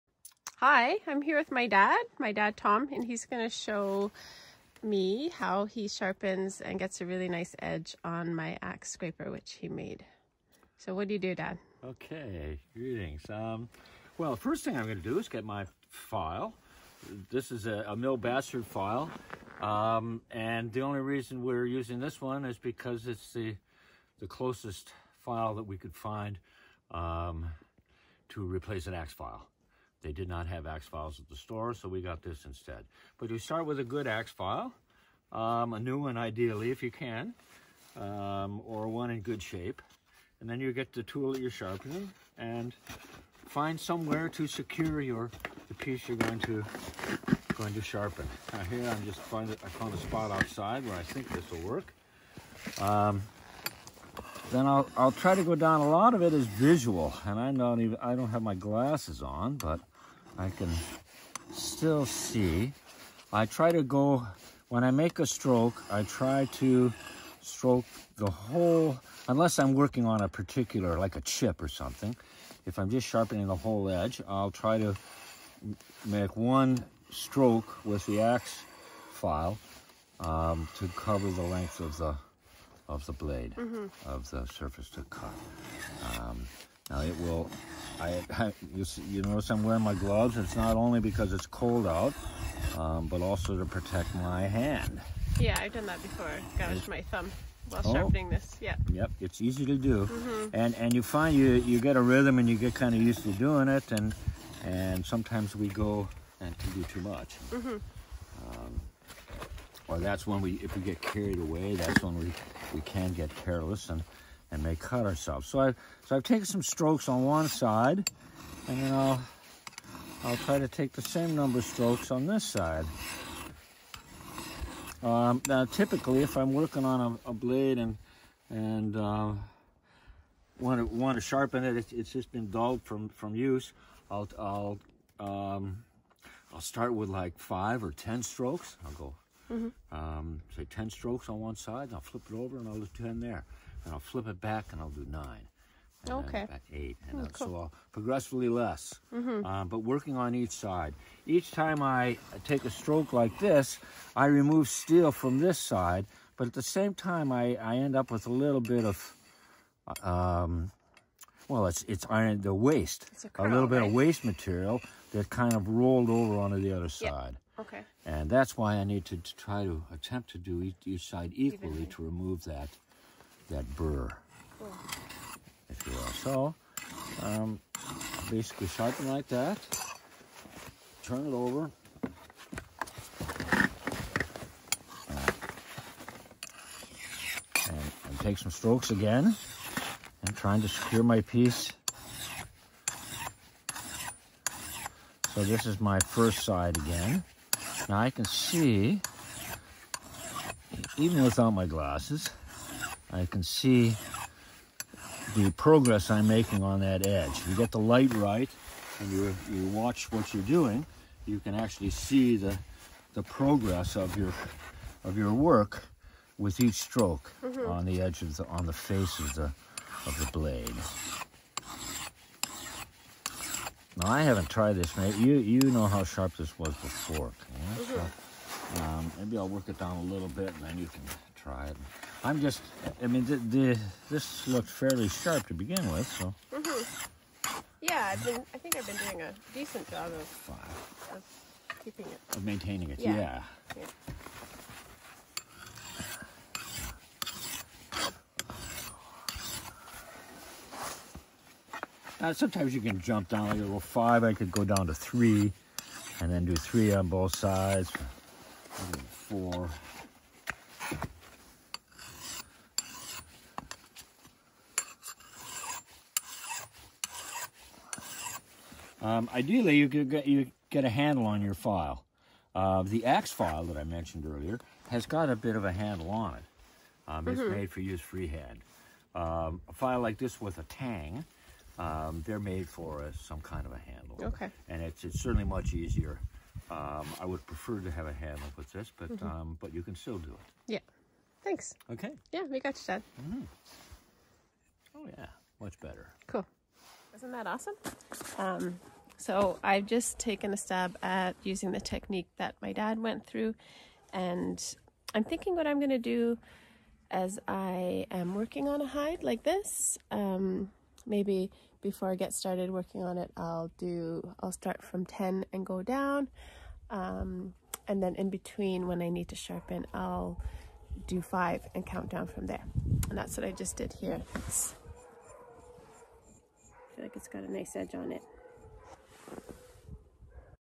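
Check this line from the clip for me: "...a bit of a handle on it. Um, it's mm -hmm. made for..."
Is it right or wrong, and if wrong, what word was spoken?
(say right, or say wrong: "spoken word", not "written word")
right.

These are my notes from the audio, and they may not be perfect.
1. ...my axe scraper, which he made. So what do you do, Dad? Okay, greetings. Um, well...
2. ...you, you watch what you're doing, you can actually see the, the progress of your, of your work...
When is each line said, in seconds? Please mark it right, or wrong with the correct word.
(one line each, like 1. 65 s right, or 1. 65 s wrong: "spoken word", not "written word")
1. 8 s right
2. 209 s right.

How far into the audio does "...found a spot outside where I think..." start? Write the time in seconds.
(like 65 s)
49 s.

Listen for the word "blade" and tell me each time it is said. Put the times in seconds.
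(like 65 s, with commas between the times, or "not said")
83 s, 127 s, 220 s.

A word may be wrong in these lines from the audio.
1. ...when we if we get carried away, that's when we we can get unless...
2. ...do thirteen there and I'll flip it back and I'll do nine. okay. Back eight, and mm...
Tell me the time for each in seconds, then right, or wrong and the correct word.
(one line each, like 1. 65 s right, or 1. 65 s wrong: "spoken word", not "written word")
1. 110 s wrong: "careless", not "unless"
2. 142 s wrong: "ten", not "thirteen".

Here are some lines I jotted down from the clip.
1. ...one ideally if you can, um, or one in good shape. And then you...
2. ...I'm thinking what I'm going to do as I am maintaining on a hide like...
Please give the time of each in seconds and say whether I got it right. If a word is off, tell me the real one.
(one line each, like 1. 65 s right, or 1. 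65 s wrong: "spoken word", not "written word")
1. 35 s right
2. 305 s wrong: "working", not "maintaining".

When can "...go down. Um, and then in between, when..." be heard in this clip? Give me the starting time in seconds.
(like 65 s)
315 s.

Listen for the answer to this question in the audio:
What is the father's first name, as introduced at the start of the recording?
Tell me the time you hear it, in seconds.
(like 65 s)
2 s.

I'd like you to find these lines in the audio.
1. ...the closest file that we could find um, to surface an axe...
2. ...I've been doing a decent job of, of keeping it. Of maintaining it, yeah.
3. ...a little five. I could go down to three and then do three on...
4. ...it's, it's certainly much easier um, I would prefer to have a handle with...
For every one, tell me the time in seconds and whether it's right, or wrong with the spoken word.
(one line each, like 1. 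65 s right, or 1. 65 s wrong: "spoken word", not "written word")
1. 24 s wrong: "replace", not "surface"
2. 238 s right
3. 253 s right
4. 284 s right.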